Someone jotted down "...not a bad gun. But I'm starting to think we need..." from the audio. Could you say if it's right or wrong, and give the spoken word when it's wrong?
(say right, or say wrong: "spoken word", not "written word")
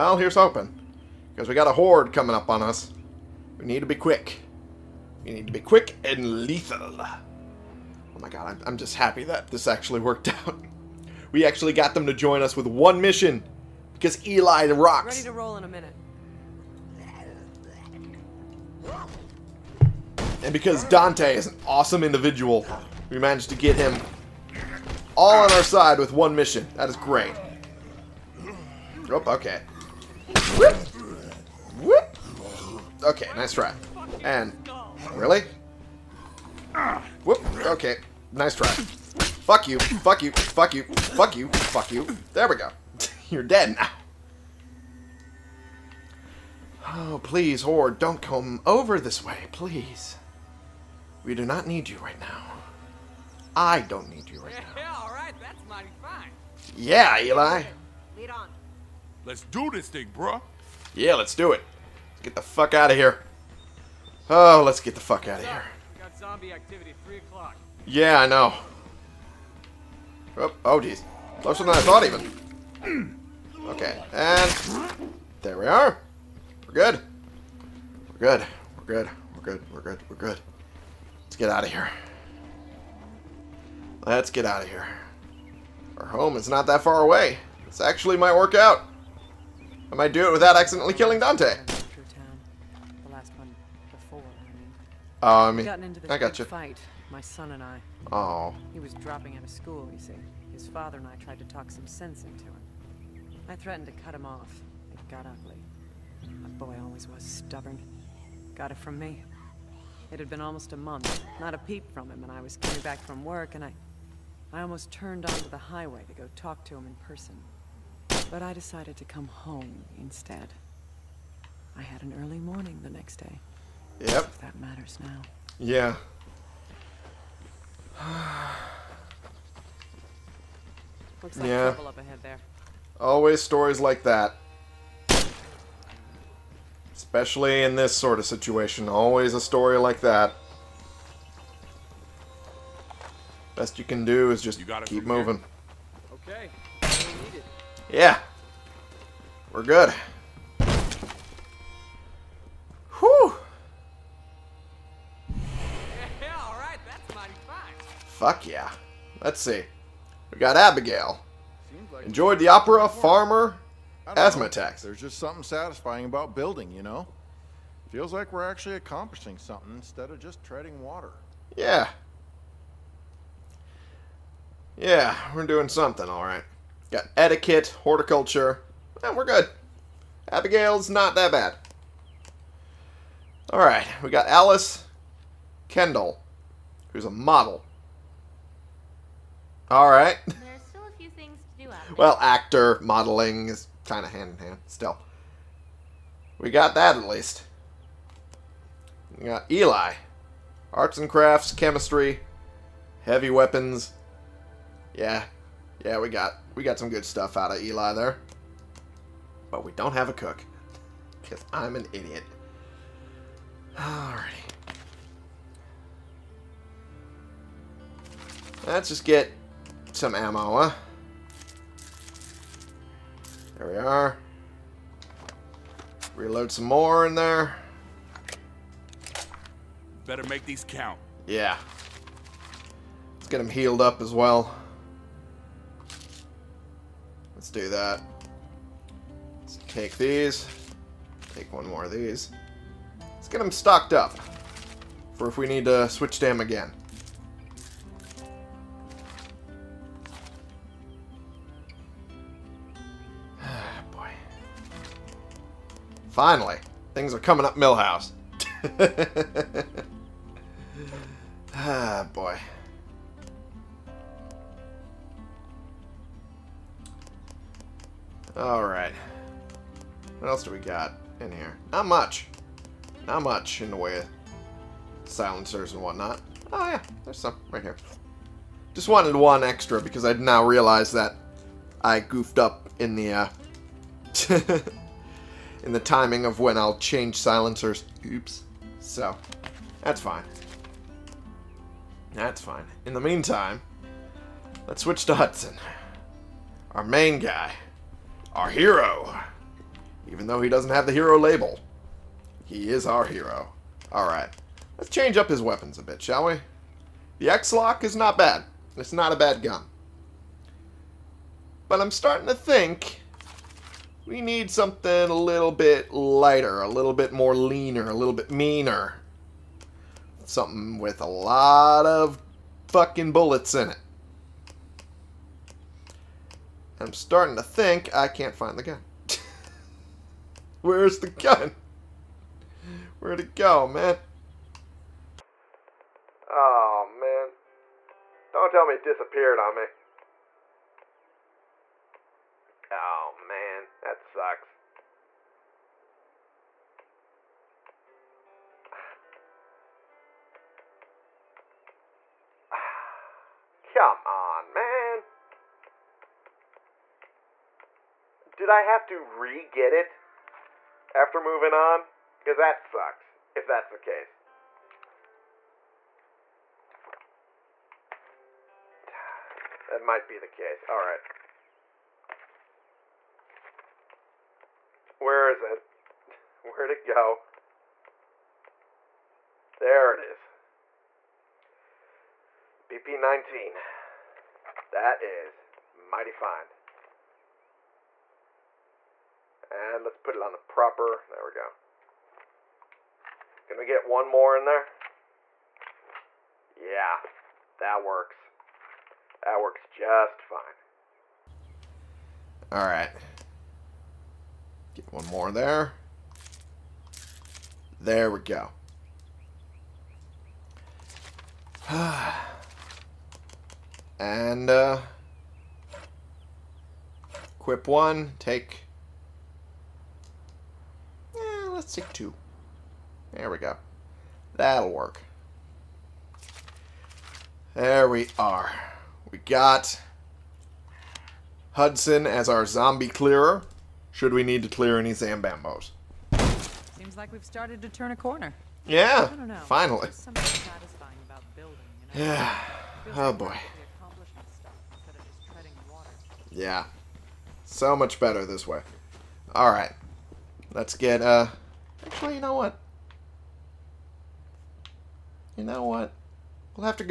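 right.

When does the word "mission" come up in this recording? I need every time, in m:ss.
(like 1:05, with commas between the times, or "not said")
0:13, 0:26.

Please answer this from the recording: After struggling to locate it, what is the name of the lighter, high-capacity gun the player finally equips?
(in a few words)
BP-19.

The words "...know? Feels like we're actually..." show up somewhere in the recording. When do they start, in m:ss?
2:46.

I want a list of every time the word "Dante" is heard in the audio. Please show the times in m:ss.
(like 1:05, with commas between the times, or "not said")
0:20, 1:31.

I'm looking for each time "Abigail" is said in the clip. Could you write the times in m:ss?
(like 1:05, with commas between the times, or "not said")
2:40, 3:00.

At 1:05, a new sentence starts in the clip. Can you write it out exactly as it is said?
We got zombie activity, 3 o'clock.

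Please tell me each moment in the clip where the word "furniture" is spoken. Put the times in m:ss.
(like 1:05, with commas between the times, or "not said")
not said.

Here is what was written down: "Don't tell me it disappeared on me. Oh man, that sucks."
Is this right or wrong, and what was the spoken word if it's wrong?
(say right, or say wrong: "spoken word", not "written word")
right.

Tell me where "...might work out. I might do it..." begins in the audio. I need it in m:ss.
1:28.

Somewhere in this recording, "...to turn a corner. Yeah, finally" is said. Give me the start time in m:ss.
7:17.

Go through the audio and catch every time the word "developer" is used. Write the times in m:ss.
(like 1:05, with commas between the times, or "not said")
not said.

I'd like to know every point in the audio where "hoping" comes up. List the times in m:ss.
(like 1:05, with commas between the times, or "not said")
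0:00.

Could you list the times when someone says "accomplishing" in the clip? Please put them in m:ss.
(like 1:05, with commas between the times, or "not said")
2:48.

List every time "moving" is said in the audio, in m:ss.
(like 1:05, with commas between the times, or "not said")
2:25, 6:01.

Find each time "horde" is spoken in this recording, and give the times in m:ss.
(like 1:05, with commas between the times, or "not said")
0:01, 0:47.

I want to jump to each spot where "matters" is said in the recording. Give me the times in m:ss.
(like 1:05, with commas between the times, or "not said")
2:04.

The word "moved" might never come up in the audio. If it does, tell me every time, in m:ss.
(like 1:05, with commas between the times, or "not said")
not said.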